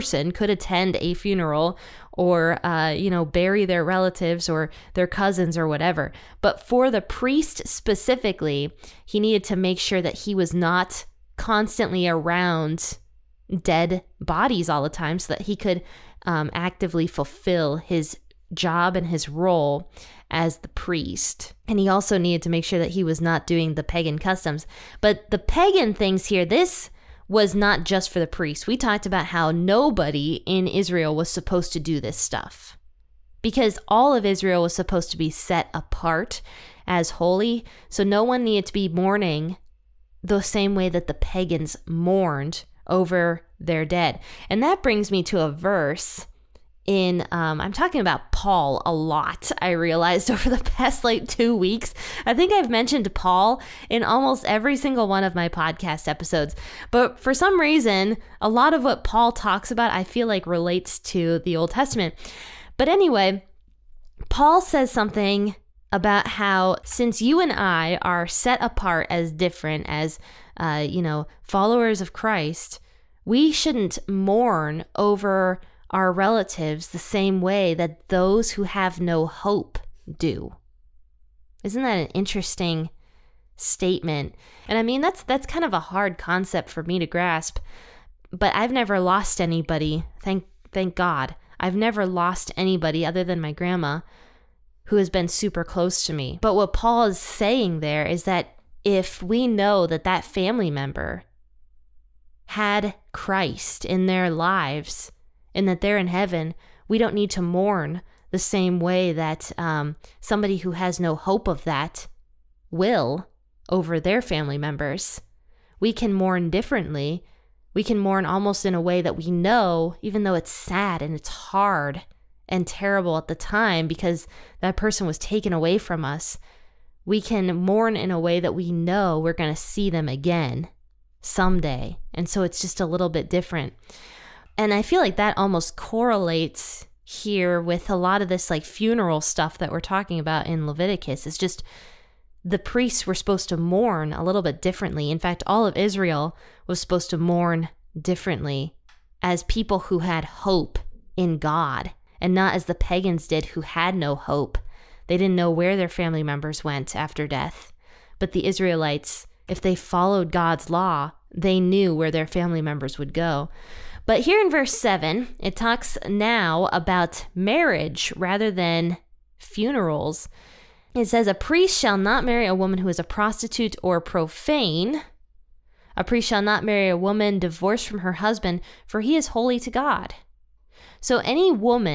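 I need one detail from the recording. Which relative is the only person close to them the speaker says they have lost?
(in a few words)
Grandma.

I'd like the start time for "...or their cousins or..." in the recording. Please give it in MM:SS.
00:04.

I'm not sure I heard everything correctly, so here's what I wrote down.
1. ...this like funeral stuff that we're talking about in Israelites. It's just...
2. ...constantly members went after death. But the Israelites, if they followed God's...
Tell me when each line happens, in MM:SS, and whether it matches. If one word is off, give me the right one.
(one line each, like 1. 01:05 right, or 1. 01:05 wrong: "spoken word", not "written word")
1. 02:18 wrong: "Leviticus", not "Israelites"
2. 02:35 wrong: "family", not "constantly".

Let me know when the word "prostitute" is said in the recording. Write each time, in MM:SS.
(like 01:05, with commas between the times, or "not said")
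02:53.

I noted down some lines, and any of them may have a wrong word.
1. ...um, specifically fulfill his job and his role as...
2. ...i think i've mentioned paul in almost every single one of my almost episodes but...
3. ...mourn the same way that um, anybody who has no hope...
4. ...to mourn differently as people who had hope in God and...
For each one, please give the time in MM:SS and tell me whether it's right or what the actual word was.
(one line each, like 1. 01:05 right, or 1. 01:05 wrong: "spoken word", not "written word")
1. 00:16 wrong: "actively", not "specifically"
2. 00:52 wrong: "podcast", not "almost"
3. 01:47 wrong: "somebody", not "anybody"
4. 02:27 right.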